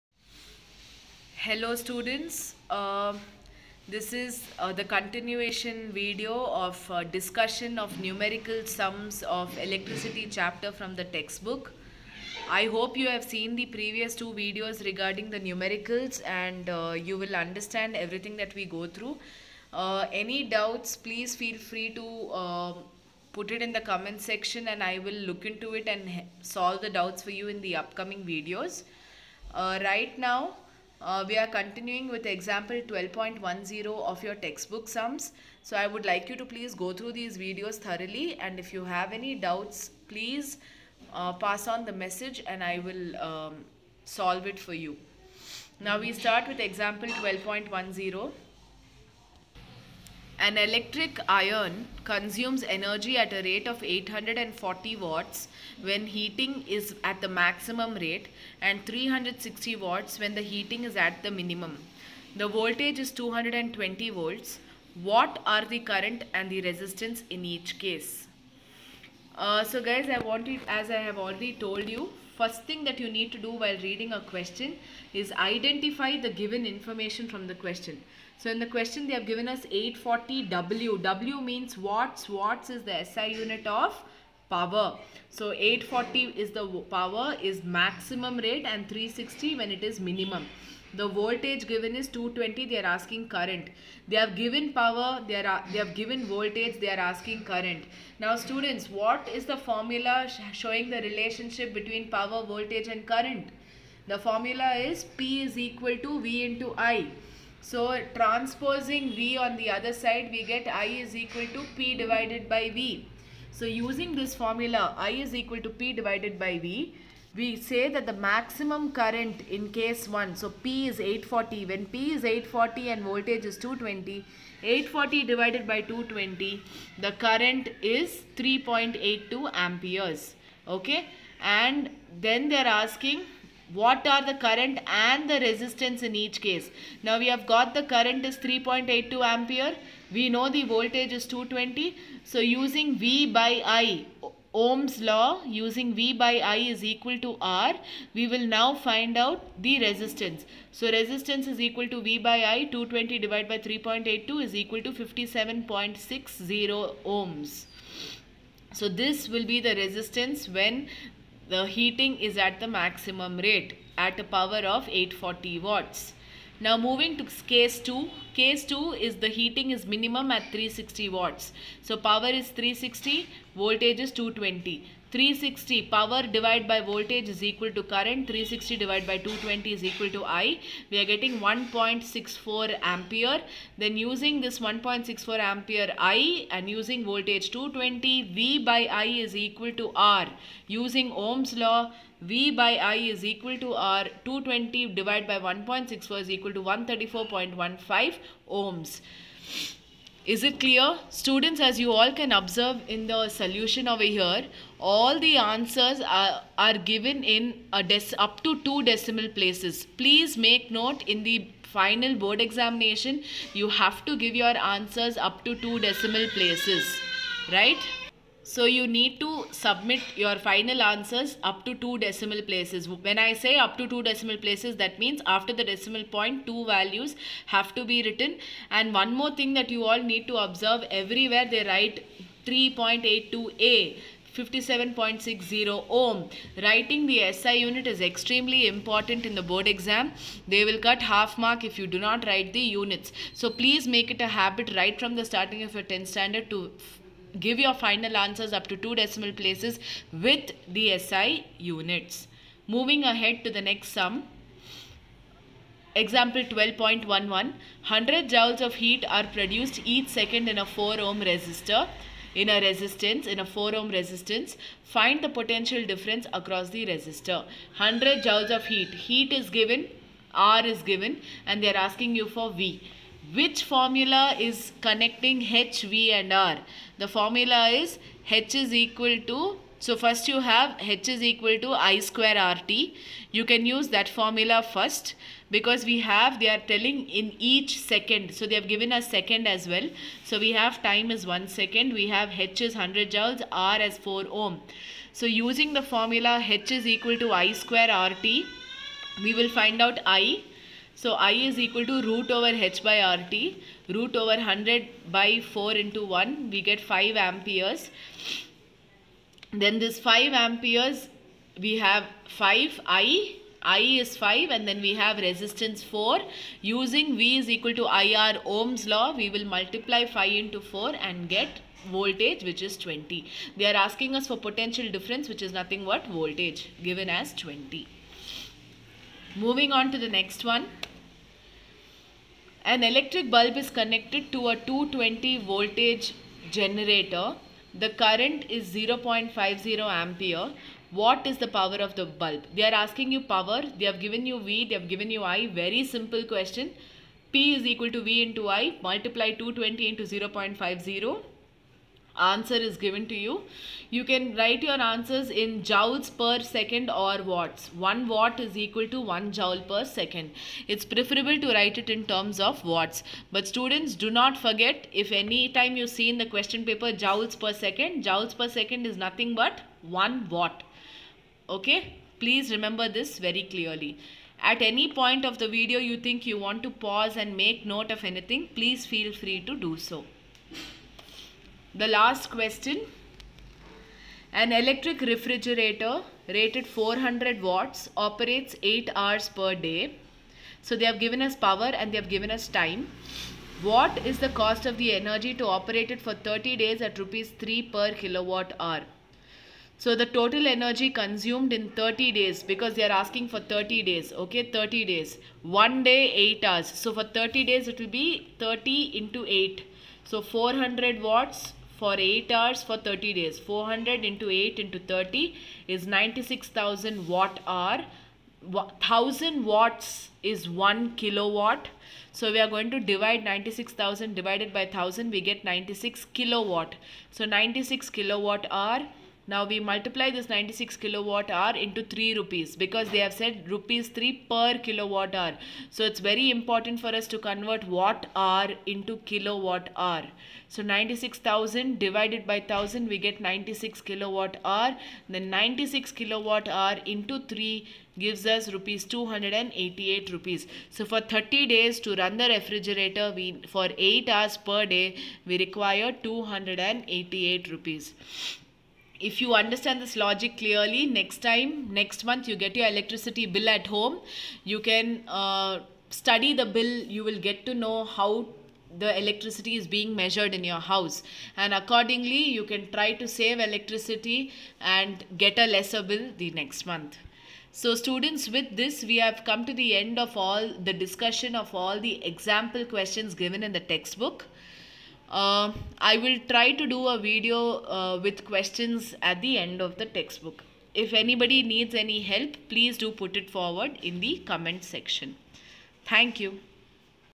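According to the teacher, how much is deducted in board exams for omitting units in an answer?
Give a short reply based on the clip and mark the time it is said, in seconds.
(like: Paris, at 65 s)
half mark, at 241 s.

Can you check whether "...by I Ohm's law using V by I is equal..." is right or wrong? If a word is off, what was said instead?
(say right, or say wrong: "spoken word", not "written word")
right.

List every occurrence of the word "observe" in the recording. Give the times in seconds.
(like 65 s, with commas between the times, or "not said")
202 s, 230 s.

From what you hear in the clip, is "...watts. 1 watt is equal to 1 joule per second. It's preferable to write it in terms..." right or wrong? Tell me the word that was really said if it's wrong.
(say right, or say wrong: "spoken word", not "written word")
right.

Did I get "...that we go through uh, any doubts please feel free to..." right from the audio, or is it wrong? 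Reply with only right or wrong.
right.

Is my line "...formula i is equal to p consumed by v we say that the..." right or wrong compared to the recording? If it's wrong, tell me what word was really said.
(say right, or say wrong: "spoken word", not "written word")
wrong: "divided", not "consumed".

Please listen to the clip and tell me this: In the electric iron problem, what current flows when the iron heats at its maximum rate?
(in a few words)
3.82 amperes.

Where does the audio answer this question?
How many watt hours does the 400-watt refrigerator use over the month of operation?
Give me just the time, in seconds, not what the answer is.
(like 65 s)
415 s.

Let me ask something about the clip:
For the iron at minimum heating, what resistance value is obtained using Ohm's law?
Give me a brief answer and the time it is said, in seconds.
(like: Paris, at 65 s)
134.15 ohms, at 196 s.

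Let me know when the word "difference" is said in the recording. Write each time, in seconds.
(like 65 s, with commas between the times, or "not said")
265 s, 324 s.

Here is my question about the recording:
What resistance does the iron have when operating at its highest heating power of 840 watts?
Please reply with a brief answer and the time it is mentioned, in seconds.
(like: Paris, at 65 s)
57.60 ohms, at 154 s.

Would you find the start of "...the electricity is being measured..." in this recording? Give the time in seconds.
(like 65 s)
468 s.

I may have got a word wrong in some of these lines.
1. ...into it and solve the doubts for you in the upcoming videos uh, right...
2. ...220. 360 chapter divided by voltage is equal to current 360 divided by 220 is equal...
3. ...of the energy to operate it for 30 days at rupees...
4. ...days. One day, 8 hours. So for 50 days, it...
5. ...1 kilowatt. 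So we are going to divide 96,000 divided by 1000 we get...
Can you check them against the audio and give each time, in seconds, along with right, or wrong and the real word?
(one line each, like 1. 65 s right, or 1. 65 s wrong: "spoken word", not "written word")
1. 25 s right
2. 174 s wrong: "power", not "chapter"
3. 394 s right
4. 404 s wrong: "30", not "50"
5. 420 s right.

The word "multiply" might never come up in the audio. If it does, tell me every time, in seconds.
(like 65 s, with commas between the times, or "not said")
319 s, 348 s, 429 s.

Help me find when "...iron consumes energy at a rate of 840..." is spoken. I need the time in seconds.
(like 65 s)
51 s.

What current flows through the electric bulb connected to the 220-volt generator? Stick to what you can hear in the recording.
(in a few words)
0.50 ampere.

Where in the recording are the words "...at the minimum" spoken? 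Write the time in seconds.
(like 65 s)
60 s.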